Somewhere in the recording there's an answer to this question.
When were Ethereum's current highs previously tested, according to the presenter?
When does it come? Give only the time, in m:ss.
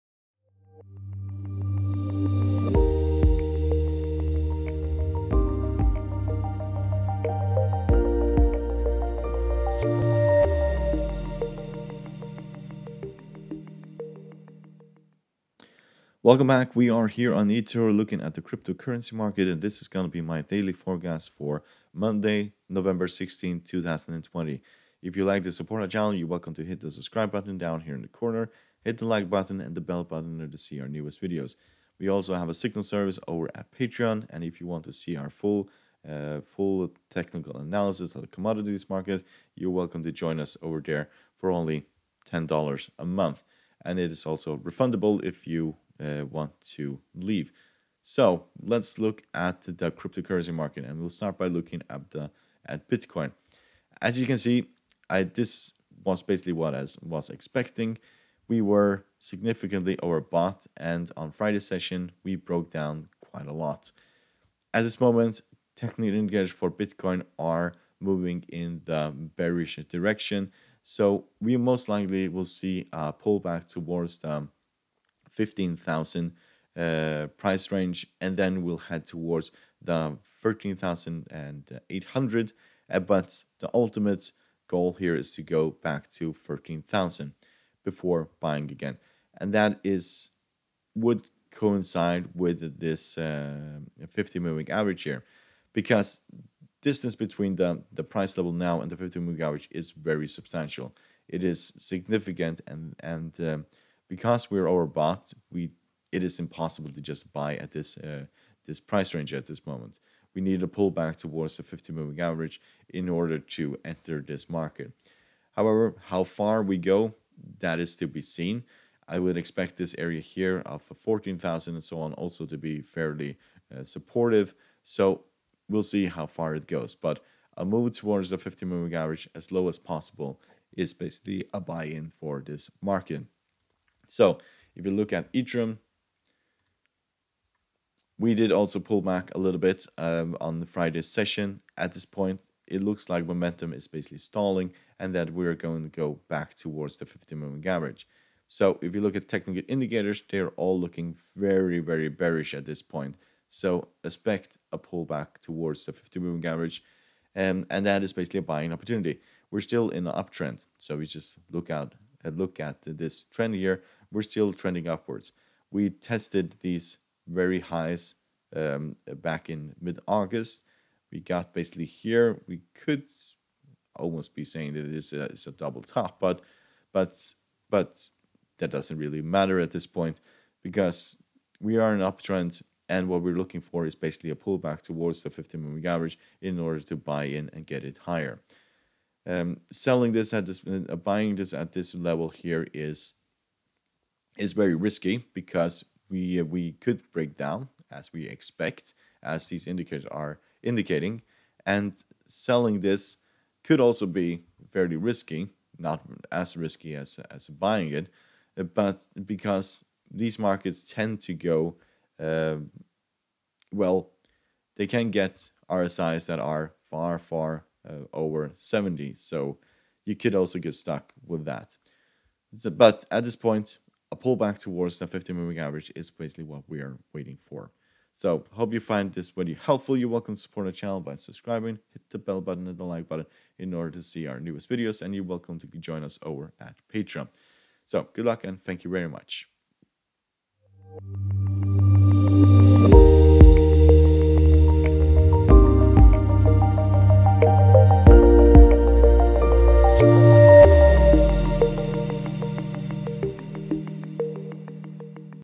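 2:49.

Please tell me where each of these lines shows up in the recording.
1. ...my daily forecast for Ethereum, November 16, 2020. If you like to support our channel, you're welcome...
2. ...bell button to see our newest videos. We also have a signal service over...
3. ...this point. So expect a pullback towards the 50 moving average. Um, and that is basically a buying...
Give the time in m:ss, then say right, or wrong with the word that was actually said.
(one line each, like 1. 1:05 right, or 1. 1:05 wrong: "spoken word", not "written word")
1. 0:20 wrong: "Monday", not "Ethereum"
2. 0:29 right
3. 2:32 right.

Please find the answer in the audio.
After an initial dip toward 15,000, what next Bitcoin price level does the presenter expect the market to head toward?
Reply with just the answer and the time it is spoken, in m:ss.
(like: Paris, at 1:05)
13,800, at 1:20.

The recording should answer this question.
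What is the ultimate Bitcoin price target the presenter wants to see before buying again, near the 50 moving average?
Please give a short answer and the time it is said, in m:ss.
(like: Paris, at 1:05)
13,000, at 1:26.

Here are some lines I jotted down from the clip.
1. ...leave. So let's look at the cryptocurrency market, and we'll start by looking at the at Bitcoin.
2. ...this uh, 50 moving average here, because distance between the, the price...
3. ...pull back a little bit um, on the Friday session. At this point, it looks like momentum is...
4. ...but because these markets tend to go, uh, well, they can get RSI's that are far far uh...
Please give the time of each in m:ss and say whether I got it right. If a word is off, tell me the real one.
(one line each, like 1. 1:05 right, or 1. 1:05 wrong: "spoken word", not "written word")
1. 0:47 right
2. 1:32 right
3. 2:18 right
4. 3:28 right.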